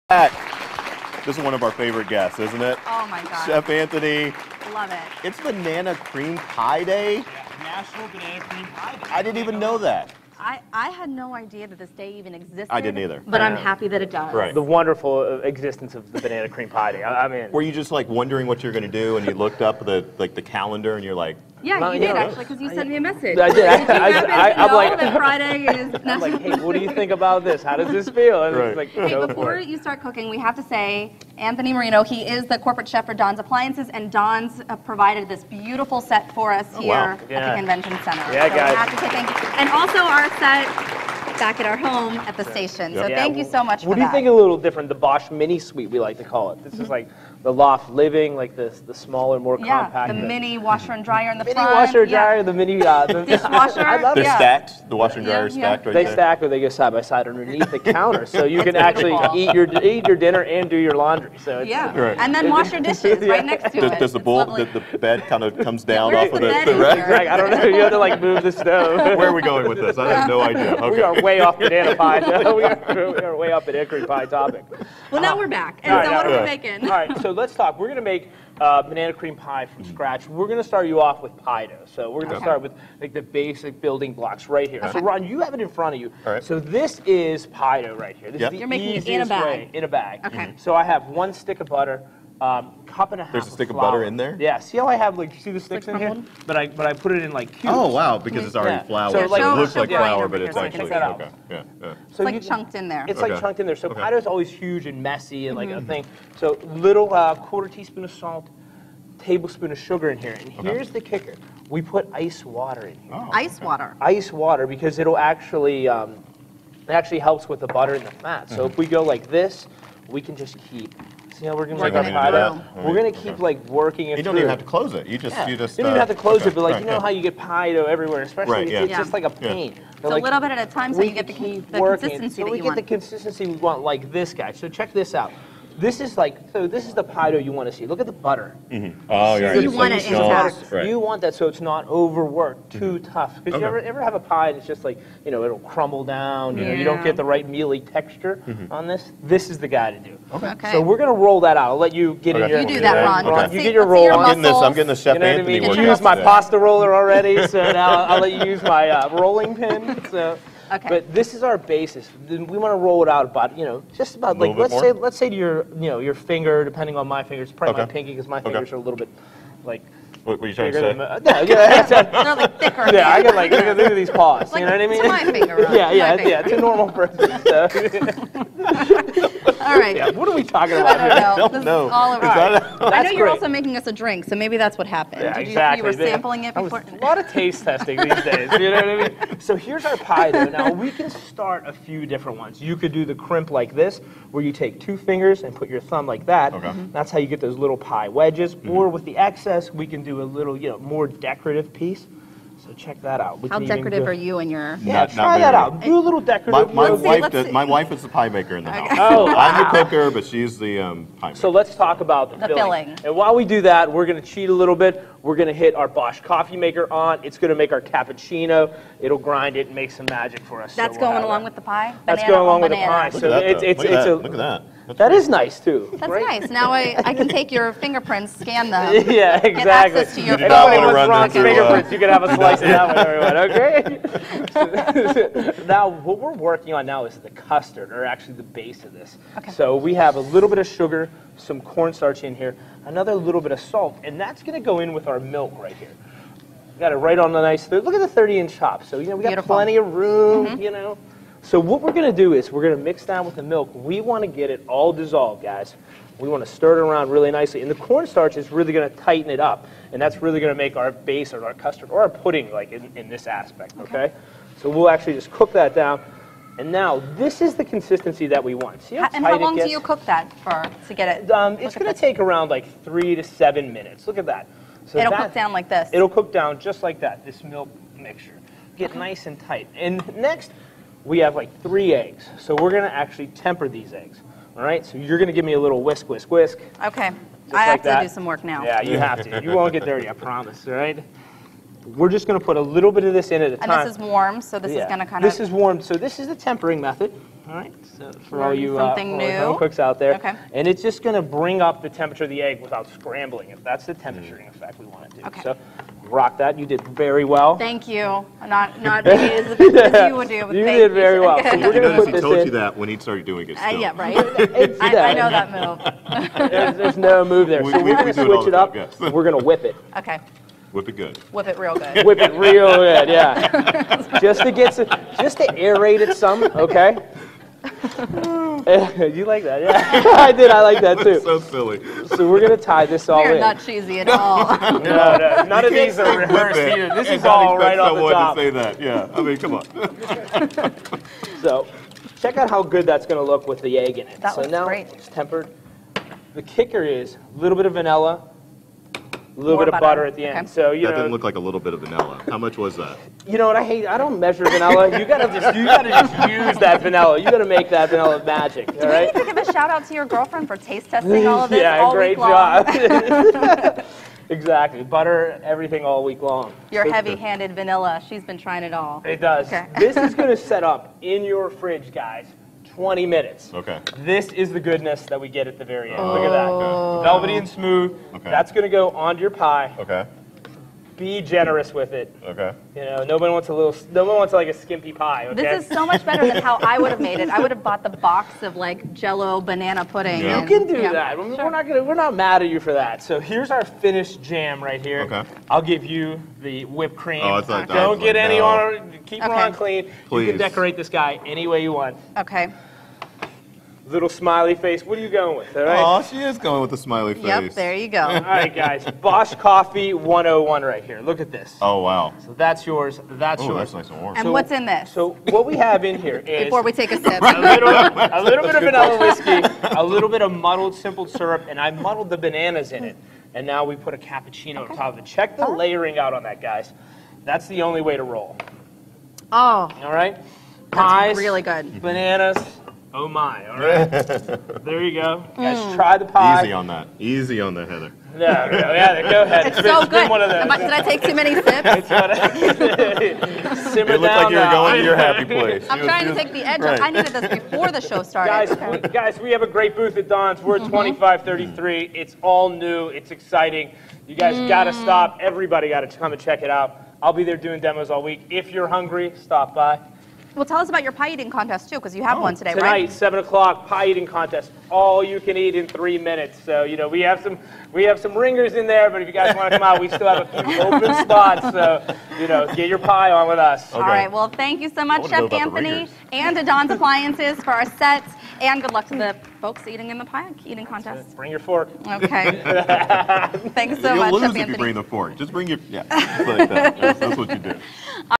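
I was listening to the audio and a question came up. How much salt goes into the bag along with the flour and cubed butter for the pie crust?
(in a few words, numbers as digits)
quarter teaspoon.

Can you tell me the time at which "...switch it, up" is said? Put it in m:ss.
5:18.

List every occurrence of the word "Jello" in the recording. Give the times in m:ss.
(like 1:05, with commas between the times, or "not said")
6:28.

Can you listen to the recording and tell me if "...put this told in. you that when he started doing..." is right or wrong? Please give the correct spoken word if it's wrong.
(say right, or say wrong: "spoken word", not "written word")
right.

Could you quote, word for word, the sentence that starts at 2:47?
my pinky because my fingers okay.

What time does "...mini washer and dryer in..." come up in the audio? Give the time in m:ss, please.
0:50.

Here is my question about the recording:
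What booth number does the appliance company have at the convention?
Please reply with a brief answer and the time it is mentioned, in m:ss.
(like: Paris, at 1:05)
2533, at 7:30.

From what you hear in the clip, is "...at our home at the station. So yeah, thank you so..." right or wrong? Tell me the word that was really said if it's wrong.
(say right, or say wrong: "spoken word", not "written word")
right.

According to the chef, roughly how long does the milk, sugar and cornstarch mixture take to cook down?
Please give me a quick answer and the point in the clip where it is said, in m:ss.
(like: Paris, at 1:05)
3 to 7 minutes, at 4:32.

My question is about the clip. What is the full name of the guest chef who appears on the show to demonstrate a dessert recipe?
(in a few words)
Anthony Marino.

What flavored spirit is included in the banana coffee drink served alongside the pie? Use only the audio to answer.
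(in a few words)
vanilla whiskey.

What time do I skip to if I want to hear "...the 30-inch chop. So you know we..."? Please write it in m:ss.
4:08.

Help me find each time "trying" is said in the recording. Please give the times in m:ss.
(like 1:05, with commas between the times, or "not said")
2:50, 6:08, 7:25.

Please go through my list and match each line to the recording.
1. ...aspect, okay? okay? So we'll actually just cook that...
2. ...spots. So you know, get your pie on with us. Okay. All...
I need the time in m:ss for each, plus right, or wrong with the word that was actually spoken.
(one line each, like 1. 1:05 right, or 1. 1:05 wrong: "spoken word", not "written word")
1. 4:23 right
2. 7:51 right.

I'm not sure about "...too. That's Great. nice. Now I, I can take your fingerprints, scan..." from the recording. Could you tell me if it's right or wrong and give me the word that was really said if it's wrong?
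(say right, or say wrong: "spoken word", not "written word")
right.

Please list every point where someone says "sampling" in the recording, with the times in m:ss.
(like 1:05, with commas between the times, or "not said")
3:06.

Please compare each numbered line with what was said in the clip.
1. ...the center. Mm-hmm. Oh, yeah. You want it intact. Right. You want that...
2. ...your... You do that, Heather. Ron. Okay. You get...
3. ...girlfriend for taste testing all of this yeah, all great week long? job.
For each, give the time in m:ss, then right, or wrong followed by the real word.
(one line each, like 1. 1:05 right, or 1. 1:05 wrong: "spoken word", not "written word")
1. 2:18 wrong: "butter", not "center"
2. 2:32 wrong: "Ron", not "Heather"
3. 6:00 right.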